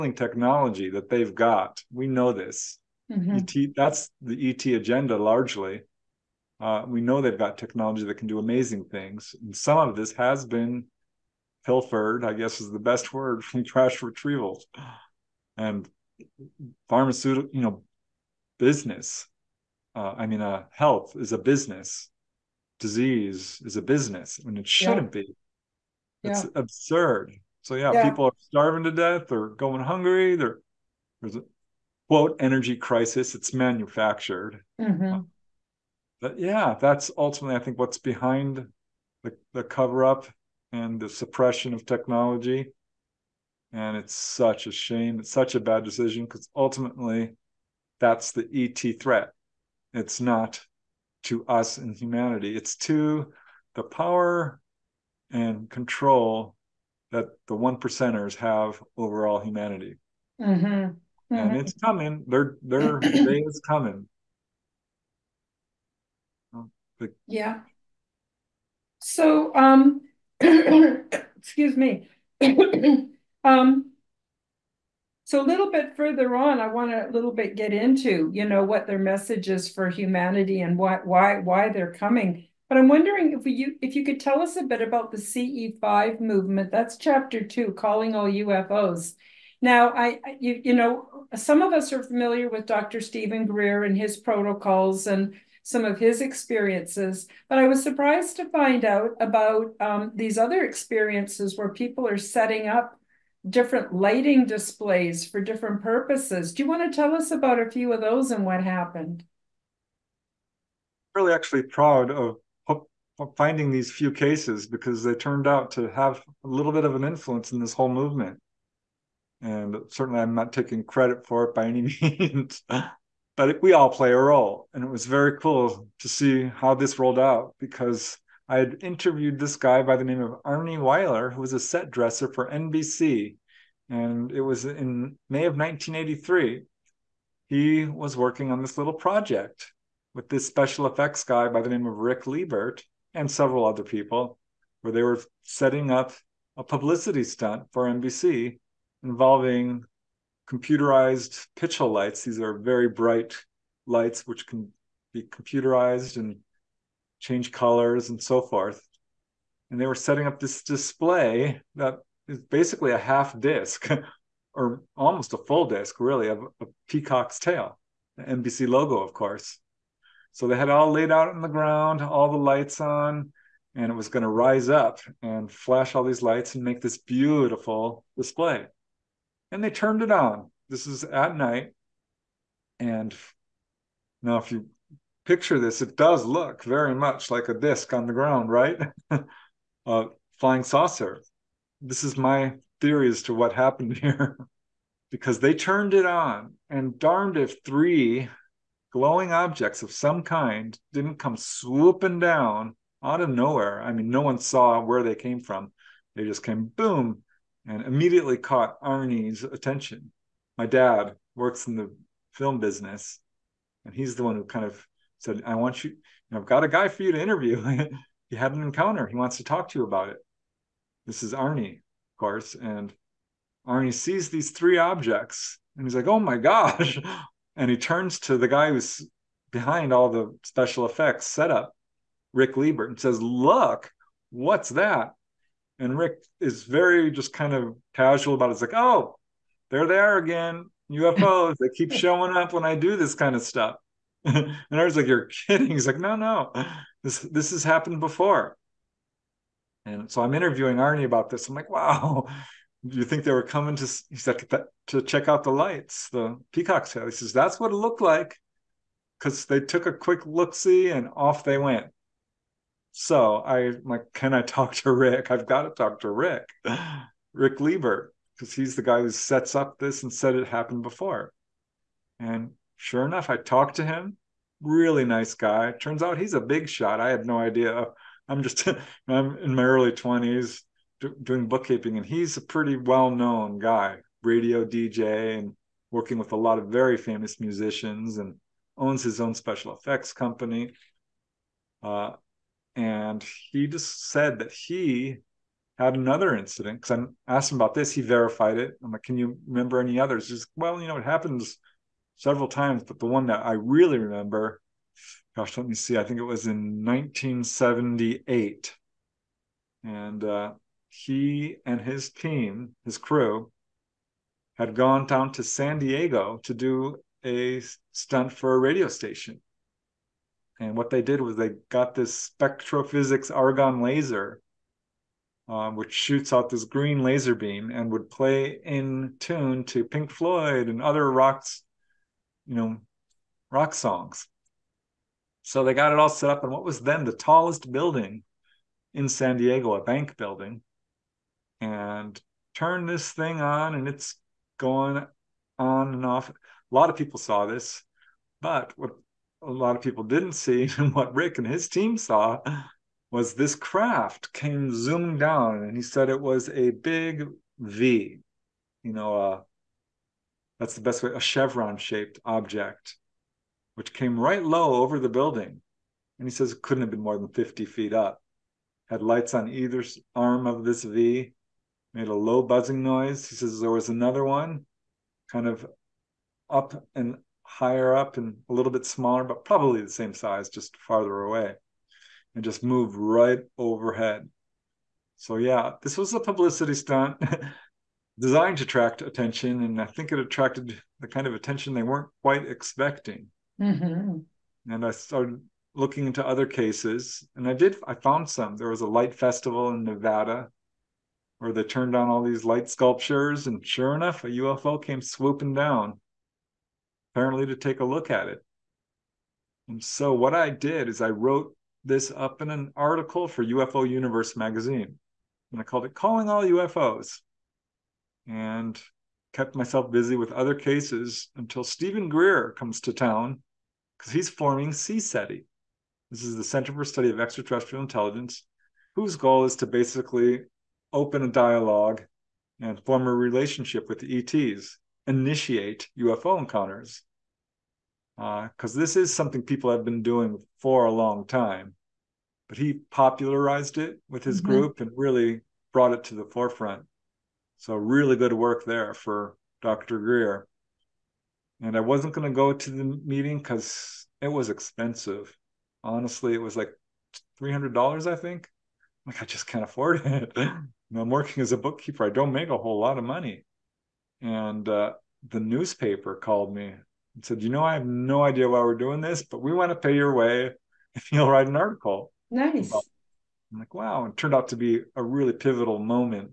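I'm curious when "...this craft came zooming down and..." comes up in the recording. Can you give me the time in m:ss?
5:53.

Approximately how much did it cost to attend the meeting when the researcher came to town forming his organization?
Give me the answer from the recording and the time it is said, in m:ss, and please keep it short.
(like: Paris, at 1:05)
$300, at 7:37.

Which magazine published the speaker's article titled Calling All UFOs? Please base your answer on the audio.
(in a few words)
UFO Universe.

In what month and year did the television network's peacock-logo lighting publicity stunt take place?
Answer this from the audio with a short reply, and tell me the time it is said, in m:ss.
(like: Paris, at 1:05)
May 1983, at 2:15.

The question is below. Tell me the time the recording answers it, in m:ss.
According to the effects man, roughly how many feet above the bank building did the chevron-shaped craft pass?
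6:07.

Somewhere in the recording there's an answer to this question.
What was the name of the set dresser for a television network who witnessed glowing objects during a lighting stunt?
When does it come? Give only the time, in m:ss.
2:10.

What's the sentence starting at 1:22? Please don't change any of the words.
But I'm wondering if you if you could tell us a bit about the CE5 movement.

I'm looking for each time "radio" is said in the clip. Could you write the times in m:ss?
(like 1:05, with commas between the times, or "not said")
4:44, 5:18.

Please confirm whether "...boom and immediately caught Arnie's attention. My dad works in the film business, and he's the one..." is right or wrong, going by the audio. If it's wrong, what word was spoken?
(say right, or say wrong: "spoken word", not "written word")
right.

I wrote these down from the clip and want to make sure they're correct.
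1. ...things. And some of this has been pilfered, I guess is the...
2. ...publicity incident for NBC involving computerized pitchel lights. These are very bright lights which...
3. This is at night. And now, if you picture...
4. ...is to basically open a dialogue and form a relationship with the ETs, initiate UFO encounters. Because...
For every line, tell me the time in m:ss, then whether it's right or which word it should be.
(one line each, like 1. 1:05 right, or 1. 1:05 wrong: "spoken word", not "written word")
1. 0:08 right
2. 2:26 wrong: "stunt", not "incident"
3. 3:00 right
4. 7:09 right.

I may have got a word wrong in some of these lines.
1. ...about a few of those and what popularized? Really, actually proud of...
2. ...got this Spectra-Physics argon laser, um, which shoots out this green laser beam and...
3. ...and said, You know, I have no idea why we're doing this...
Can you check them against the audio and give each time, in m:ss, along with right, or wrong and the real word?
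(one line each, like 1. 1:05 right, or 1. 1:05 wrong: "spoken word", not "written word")
1. 1:47 wrong: "happened", not "popularized"
2. 5:21 right
3. 7:47 right.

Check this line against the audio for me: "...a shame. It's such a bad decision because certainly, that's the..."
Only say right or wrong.
wrong.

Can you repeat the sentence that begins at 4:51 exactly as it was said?
Uh, and he just said that he had another incident because I asked him about this.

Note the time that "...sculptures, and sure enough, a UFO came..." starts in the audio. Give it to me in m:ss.
6:42.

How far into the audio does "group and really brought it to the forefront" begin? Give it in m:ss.
7:24.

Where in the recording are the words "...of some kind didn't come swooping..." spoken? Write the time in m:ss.
3:19.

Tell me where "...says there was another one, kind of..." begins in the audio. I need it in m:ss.
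6:13.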